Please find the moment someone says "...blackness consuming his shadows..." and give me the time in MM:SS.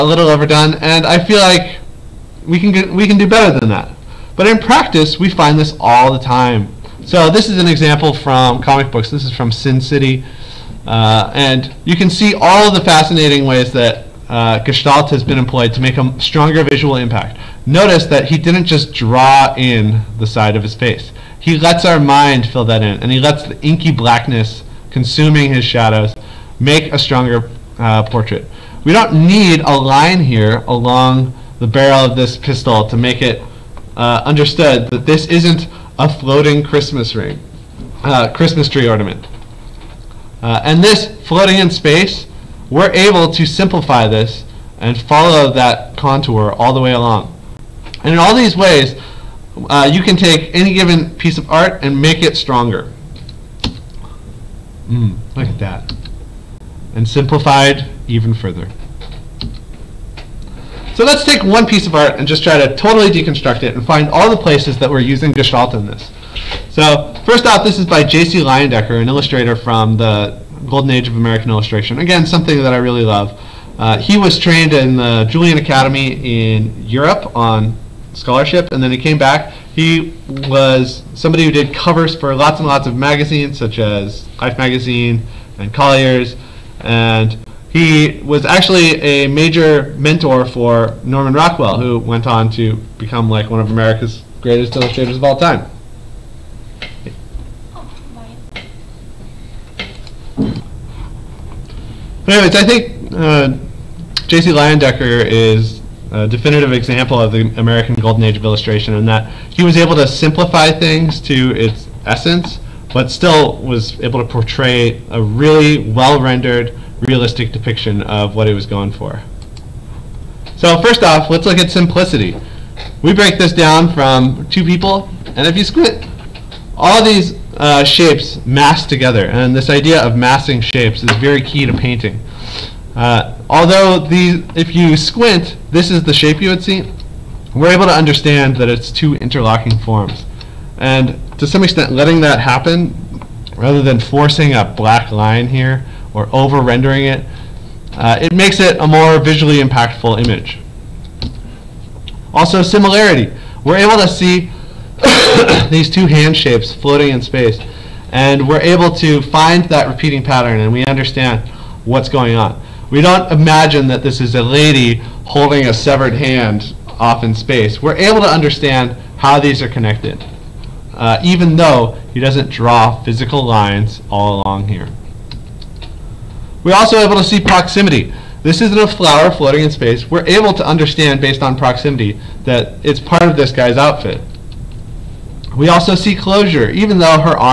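00:23.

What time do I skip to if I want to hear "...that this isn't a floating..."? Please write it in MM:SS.
00:34.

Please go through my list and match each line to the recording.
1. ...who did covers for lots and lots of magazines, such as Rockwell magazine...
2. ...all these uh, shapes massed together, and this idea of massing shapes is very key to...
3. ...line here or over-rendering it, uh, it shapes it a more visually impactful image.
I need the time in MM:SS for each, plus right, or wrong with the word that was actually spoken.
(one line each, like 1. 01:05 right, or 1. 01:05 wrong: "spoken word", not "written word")
1. 01:21 wrong: "Life", not "Rockwell"
2. 02:06 right
3. 02:25 wrong: "makes", not "shapes".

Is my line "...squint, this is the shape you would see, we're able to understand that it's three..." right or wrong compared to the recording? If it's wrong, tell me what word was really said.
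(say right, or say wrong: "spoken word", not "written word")
wrong: "two", not "three".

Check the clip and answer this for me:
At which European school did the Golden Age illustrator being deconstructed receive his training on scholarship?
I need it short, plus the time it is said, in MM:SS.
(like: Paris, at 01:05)
Julian Academy, at 01:15.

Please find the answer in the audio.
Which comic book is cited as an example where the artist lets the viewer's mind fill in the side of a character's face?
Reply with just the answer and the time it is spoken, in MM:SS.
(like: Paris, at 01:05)
Sin City, at 00:09.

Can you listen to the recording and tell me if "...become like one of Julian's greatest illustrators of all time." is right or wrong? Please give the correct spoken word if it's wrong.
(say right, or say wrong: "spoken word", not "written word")
wrong: "America", not "Julian".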